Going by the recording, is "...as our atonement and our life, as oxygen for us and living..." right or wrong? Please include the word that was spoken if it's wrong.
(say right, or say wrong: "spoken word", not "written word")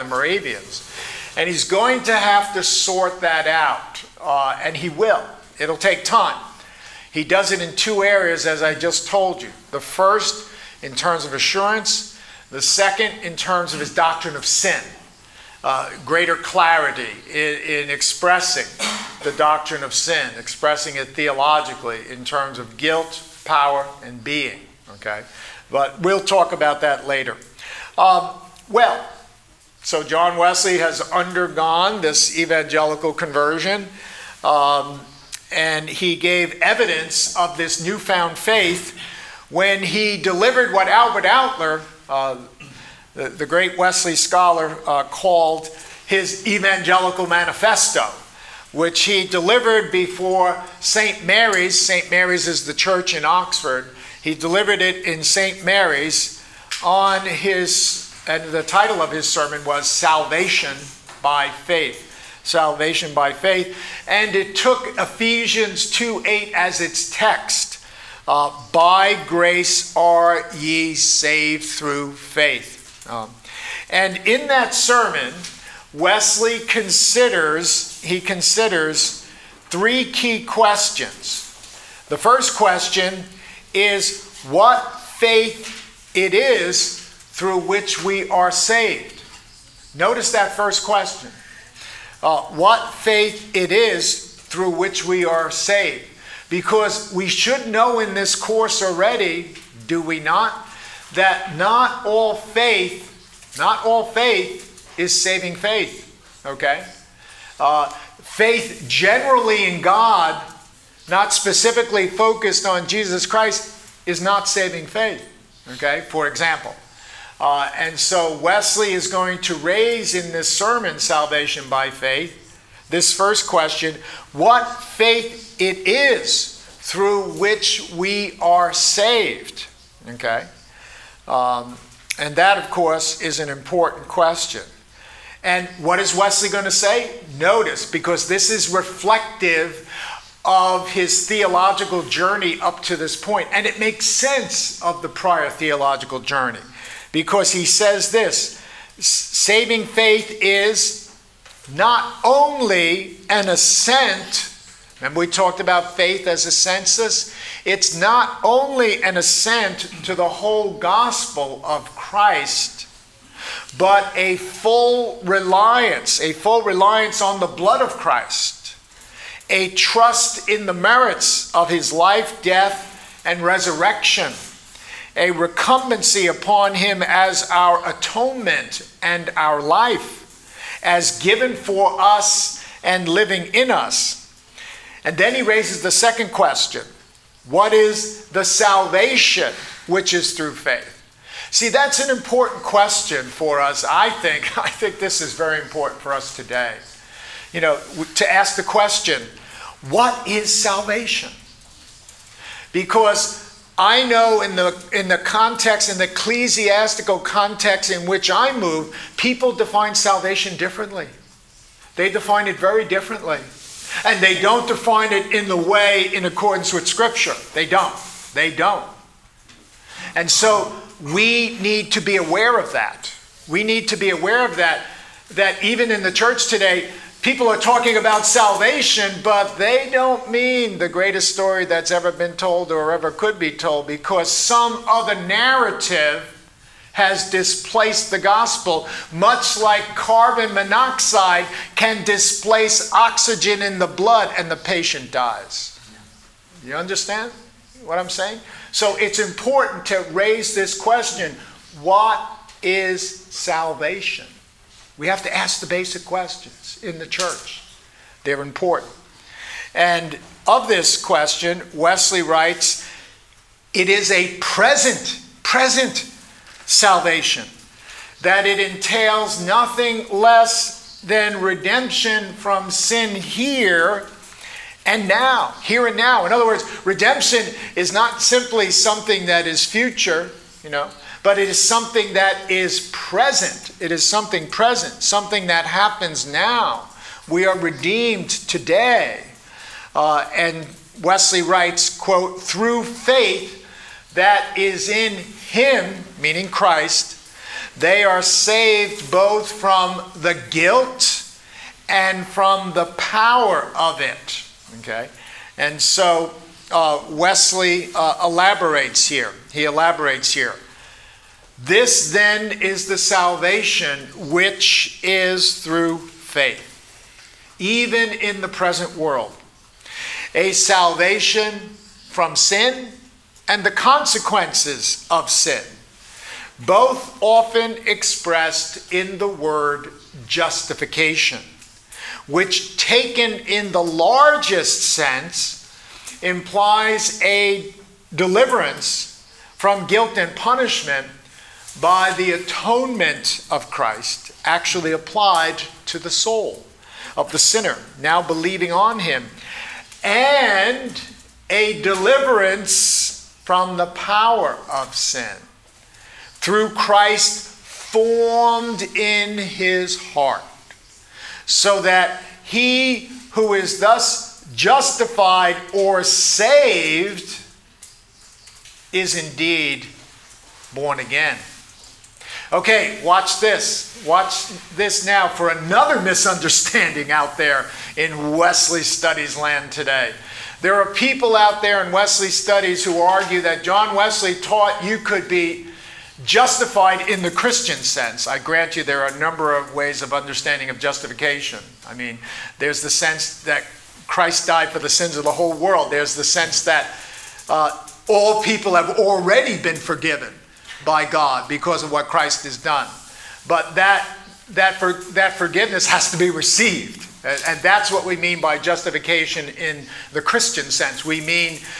wrong: "given", not "oxygen".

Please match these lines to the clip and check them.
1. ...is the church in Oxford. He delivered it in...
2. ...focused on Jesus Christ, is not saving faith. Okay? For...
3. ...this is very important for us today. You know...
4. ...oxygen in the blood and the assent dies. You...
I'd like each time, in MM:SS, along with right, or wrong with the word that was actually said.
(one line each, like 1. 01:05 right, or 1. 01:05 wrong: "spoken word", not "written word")
1. 00:52 right
2. 01:52 right
3. 03:14 right
4. 04:02 wrong: "patient", not "assent".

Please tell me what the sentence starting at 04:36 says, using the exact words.
In other words, redemption is not simply something that is future, you know, but it is something that is present.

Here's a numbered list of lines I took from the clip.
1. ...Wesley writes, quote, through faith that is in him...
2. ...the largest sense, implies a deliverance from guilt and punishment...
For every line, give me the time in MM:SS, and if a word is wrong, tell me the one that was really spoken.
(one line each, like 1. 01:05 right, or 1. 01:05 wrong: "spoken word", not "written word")
1. 04:51 right
2. 05:33 right.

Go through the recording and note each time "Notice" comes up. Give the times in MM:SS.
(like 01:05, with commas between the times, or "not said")
01:29, 02:17.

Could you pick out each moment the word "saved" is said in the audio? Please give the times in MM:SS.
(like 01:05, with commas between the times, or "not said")
01:10, 01:28, 01:35, 02:08, 04:58, 06:06.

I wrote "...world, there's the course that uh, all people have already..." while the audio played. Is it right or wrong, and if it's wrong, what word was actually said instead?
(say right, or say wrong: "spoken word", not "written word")
wrong: "sense", not "course".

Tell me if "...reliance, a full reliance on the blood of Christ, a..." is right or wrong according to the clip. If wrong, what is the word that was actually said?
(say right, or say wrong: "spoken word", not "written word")
right.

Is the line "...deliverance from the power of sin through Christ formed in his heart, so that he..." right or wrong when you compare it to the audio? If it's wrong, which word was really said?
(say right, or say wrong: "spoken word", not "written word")
right.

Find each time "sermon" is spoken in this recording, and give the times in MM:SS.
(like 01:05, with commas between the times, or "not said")
00:59, 01:14, 02:00.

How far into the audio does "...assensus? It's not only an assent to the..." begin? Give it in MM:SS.
02:36.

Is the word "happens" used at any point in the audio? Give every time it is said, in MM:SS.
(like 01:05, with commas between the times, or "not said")
04:45.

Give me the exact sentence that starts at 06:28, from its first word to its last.
I grant you there are a number of ways of understanding of justification.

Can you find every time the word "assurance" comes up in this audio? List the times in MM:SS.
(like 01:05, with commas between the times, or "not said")
00:11.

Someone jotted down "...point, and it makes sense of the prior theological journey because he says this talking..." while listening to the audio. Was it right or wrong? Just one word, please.
wrong.